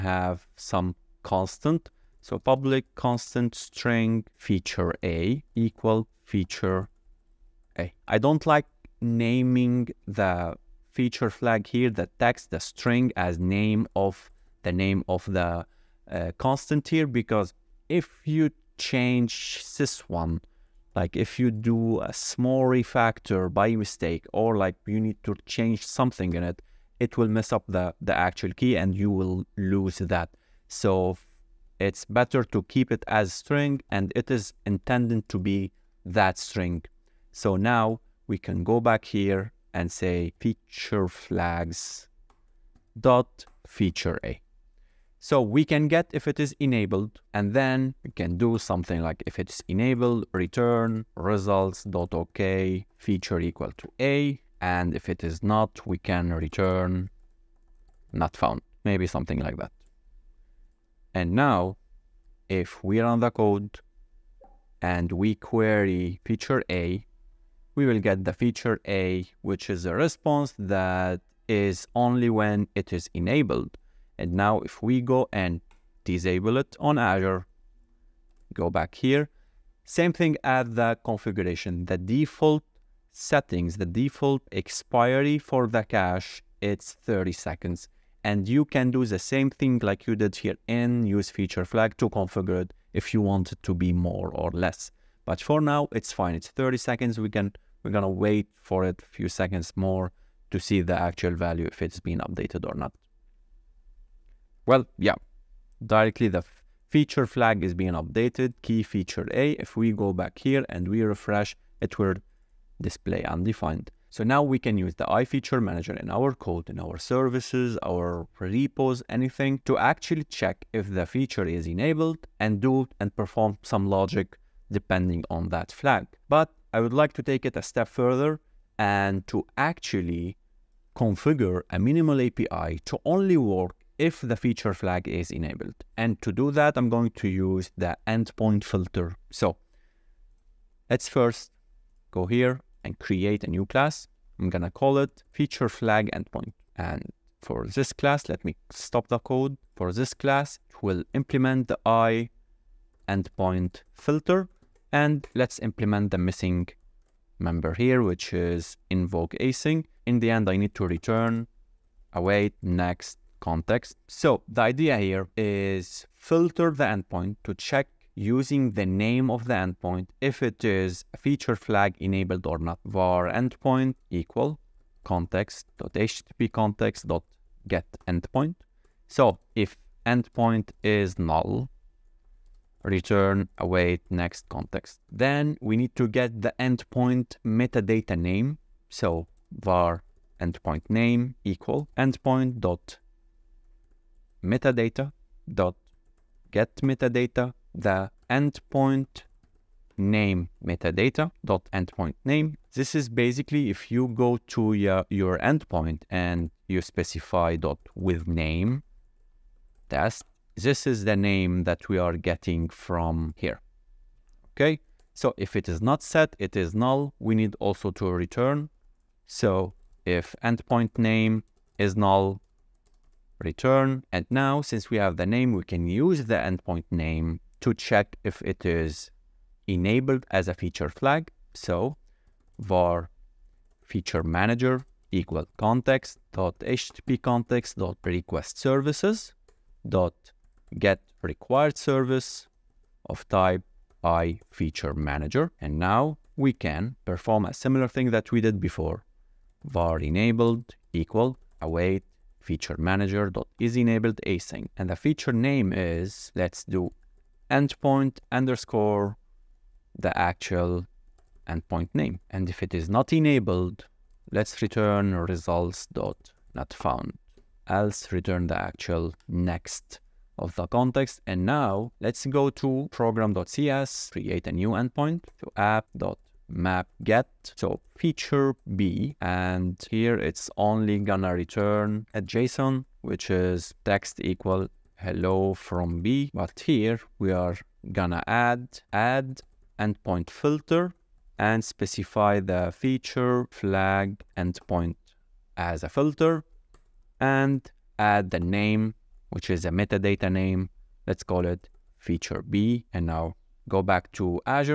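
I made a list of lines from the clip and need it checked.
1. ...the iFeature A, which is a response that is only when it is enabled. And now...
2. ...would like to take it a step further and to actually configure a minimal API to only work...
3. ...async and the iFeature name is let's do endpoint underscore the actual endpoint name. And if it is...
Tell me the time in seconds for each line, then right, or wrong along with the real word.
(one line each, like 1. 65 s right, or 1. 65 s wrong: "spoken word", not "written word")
1. 68 s wrong: "feature", not "iFeature"
2. 126 s right
3. 254 s wrong: "feature", not "iFeature".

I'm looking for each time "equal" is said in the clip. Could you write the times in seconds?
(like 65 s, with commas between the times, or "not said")
5 s, 53 s, 174 s, 191 s, 235 s, 251 s, 284 s.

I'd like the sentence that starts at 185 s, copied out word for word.
Then we need to get the endpoint metadata name.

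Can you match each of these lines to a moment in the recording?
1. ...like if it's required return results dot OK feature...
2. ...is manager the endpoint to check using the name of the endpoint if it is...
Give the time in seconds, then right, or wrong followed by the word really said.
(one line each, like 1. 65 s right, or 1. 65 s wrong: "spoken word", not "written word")
1. 49 s wrong: "enabled", not "required"
2. 165 s wrong: "filter", not "manager".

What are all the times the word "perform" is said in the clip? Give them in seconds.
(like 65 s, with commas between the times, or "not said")
123 s, 247 s.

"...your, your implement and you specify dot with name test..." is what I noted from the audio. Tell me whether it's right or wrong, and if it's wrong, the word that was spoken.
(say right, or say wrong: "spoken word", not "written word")
wrong: "endpoint", not "implement".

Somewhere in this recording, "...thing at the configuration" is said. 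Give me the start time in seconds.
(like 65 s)
80 s.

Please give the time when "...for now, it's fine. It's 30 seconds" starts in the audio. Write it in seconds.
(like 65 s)
95 s.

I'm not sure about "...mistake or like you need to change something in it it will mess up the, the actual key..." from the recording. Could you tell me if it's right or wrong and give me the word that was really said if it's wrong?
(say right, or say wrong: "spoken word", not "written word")
right.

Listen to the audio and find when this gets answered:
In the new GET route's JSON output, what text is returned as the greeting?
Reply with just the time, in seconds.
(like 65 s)
285 s.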